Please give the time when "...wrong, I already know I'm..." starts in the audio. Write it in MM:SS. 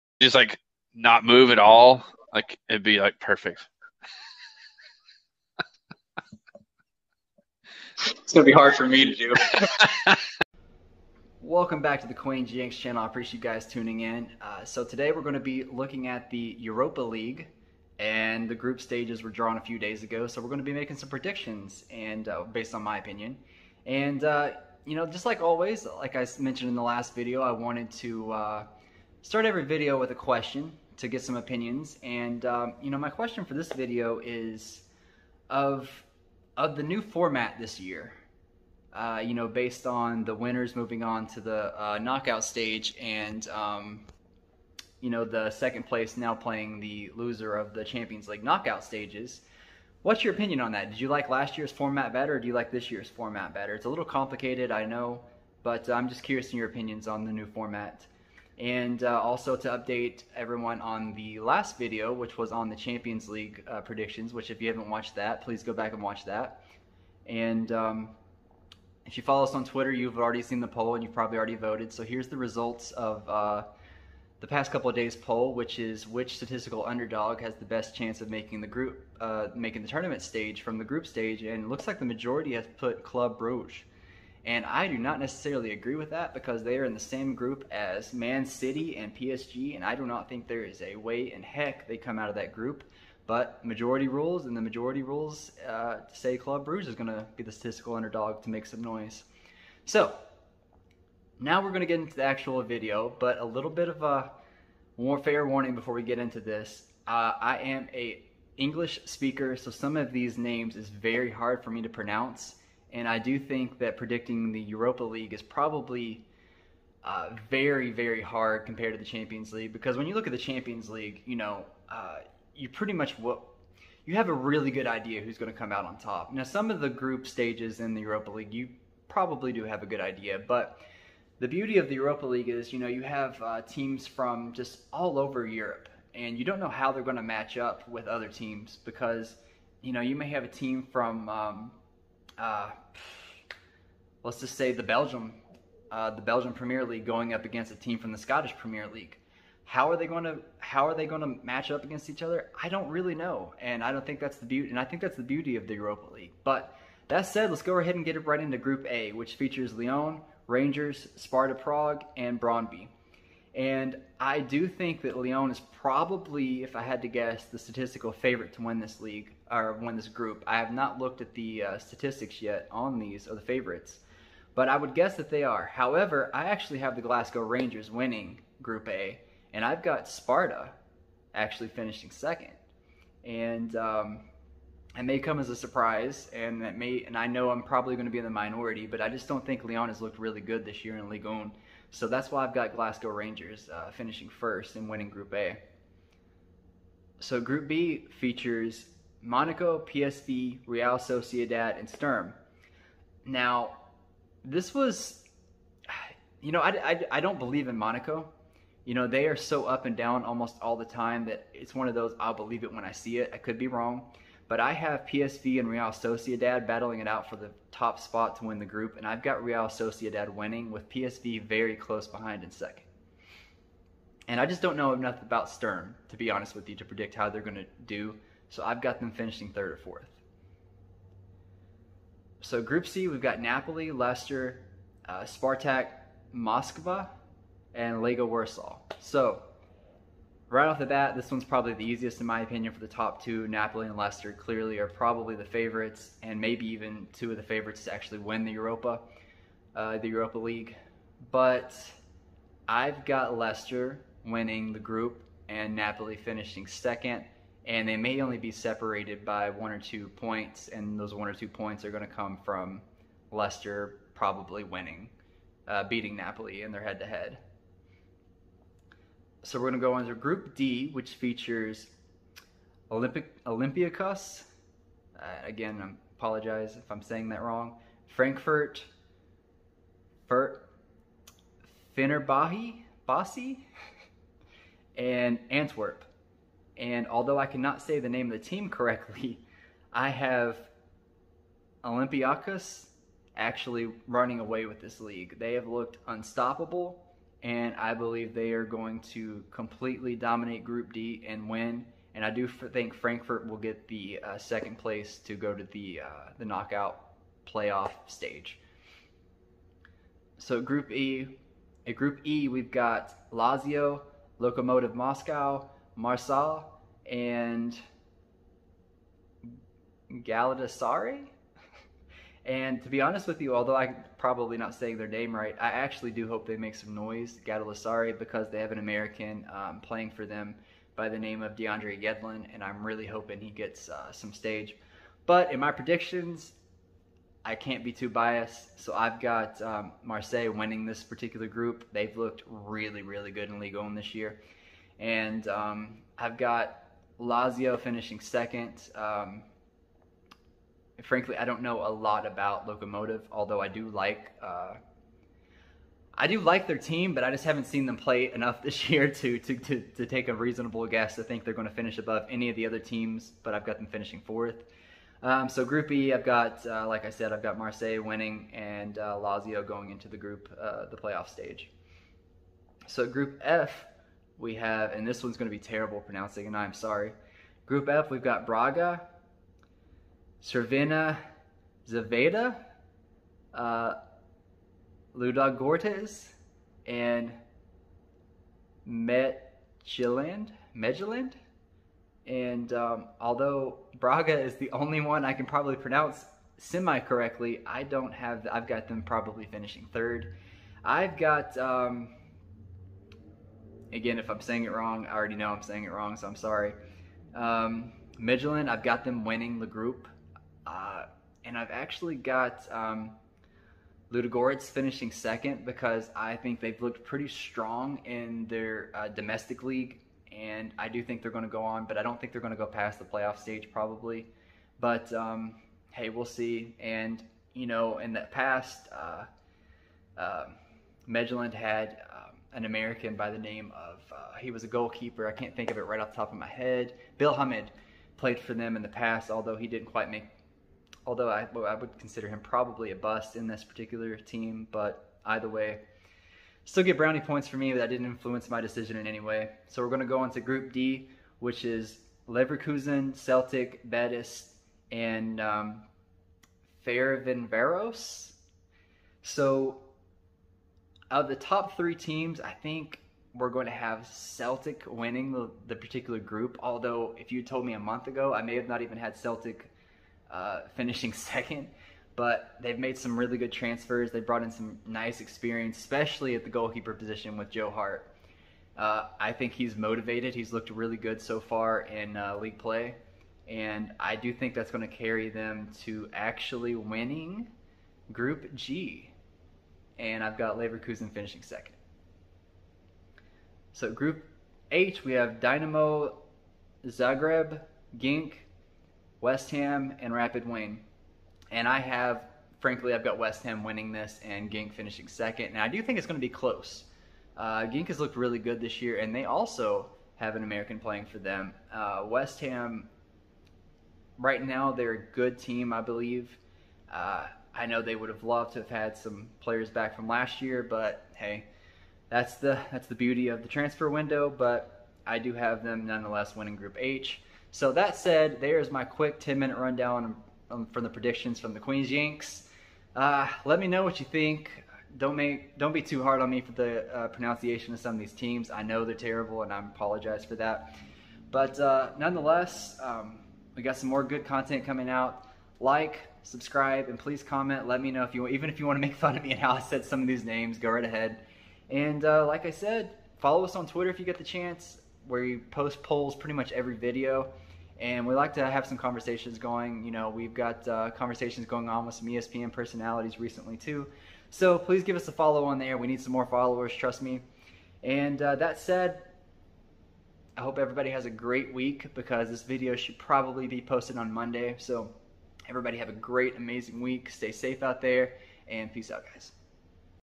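06:44.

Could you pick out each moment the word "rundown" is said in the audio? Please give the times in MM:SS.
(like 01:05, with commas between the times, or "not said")
08:49.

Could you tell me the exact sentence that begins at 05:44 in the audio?
And um, I've got Lazio finishing second.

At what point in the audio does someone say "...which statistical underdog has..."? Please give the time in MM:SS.
01:16.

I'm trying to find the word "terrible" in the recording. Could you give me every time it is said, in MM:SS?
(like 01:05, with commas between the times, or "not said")
06:15, 08:58.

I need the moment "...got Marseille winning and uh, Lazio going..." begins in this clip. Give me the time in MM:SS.
06:07.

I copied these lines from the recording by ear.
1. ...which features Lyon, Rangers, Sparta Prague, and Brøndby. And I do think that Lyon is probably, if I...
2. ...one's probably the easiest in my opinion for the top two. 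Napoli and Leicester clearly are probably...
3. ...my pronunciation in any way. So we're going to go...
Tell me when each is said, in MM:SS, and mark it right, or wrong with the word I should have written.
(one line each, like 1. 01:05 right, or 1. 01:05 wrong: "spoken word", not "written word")
1. 02:39 right
2. 04:01 right
3. 07:28 wrong: "decision", not "pronunciation".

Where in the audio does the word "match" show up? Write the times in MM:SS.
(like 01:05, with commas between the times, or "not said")
02:17, 02:31.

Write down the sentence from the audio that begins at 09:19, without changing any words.
You know, we've got uh, conversations going on with some ESPN personalities recently too.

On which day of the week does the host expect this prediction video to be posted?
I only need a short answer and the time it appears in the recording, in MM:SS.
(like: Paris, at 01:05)
Monday, at 09:34.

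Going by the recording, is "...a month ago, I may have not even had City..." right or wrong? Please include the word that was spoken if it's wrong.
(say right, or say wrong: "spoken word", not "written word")
wrong: "Celtic", not "City".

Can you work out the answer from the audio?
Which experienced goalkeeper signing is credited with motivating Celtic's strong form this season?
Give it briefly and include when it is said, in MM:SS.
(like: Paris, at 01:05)
Joe Hart, at 07:57.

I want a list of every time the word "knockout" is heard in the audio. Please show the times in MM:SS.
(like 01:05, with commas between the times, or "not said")
00:41, 00:48, 05:06.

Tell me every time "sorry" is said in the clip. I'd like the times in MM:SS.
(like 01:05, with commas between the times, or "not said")
06:16, 06:46.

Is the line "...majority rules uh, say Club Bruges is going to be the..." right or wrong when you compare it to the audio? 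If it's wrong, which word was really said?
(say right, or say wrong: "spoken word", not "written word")
right.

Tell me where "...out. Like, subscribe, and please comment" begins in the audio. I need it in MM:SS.
09:04.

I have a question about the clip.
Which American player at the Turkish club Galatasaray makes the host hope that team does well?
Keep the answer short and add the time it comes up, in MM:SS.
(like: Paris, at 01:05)
DeAndre Yedlin, at 05:31.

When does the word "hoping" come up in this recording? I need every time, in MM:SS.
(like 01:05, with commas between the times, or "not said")
05:33.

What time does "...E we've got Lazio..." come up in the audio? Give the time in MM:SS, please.
05:12.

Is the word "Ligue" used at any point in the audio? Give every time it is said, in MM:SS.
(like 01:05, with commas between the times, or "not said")
03:11, 05:43.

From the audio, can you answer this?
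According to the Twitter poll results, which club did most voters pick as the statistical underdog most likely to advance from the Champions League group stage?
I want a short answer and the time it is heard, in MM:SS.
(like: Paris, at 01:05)
Club Brugge, at 01:23.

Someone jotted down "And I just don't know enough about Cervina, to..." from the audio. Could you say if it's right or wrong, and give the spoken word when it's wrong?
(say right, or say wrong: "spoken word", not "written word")
wrong: "Sturm", not "Cervina".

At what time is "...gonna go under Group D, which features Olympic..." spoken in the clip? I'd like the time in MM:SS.
04:29.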